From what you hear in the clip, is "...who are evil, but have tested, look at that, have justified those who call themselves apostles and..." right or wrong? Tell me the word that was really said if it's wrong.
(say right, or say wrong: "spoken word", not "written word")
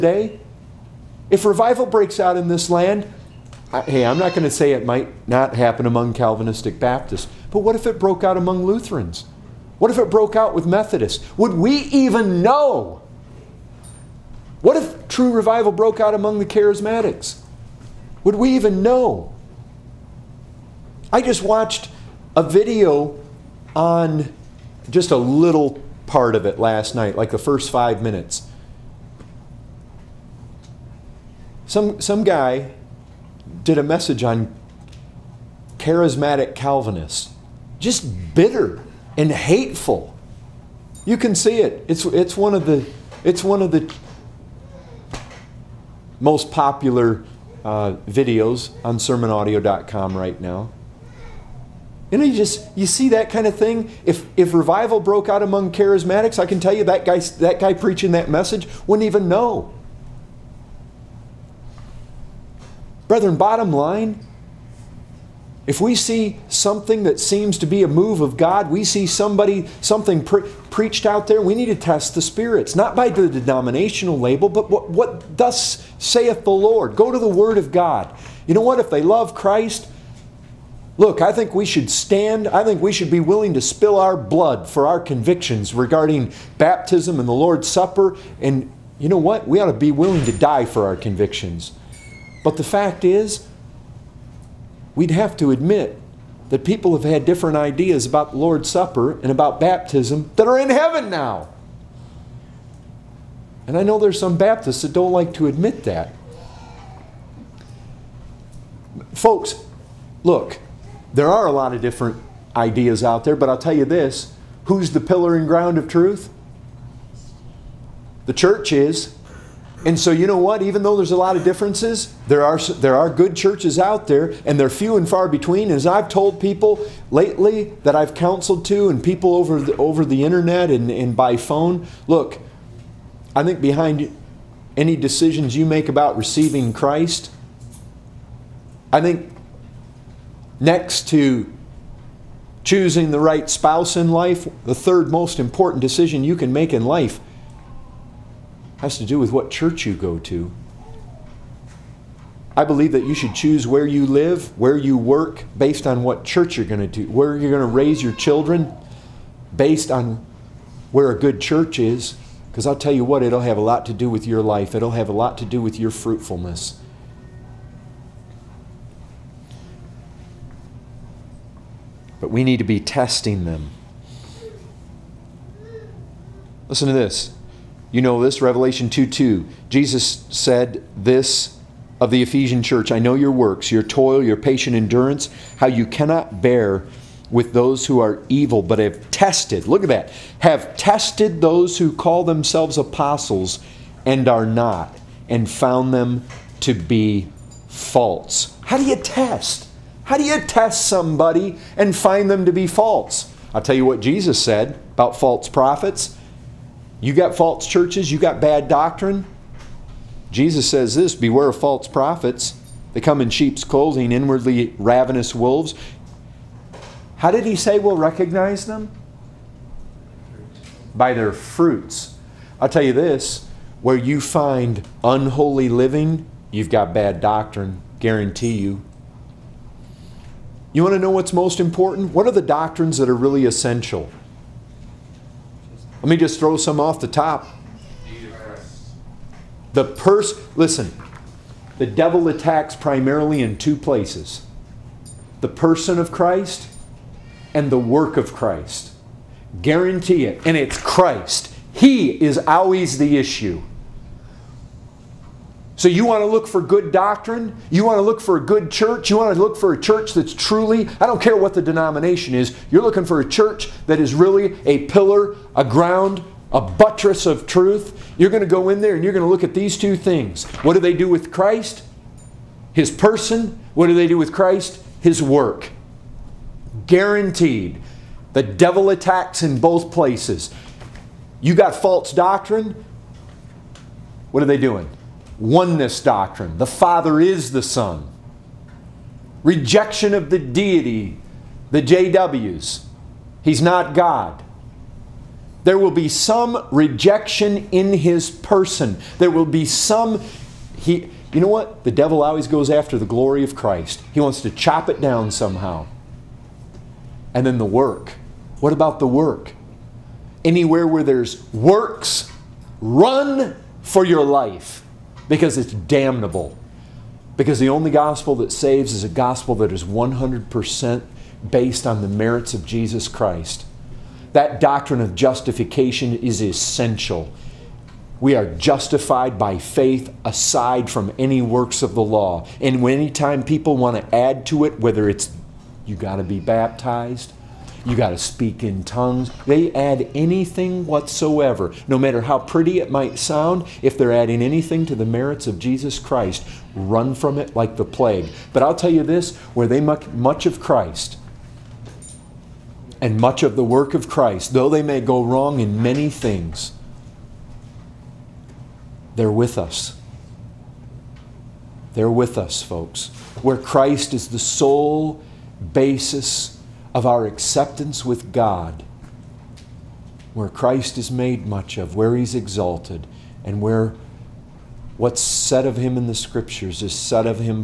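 wrong: "tested", not "justified".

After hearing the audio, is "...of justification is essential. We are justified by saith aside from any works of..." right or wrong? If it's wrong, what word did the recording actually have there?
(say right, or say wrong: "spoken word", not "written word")
wrong: "faith", not "saith".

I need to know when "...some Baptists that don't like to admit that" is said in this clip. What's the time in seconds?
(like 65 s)
104 s.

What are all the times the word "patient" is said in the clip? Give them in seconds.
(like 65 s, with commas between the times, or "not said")
184 s.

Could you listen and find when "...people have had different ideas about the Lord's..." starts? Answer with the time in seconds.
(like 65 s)
96 s.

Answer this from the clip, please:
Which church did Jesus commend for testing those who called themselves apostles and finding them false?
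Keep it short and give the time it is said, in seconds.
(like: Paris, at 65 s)
Ephesian church, at 182 s.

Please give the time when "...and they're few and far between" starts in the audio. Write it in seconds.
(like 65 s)
124 s.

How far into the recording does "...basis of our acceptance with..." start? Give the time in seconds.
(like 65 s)
365 s.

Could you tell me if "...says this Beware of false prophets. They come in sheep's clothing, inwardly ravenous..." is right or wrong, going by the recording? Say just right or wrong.
right.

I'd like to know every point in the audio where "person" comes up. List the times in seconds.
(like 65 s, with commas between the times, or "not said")
245 s, 272 s, 298 s.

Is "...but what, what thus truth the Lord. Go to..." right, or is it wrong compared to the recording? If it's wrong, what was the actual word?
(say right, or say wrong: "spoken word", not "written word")
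wrong: "saith", not "truth".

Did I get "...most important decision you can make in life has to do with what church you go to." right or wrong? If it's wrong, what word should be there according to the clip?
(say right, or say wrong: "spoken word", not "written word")
right.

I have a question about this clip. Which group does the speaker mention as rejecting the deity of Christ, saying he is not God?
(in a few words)
JWs.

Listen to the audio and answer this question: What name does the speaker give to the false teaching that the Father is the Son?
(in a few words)
Oneness doctrine.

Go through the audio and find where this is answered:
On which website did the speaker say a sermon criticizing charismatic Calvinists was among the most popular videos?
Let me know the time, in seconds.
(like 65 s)
48 s.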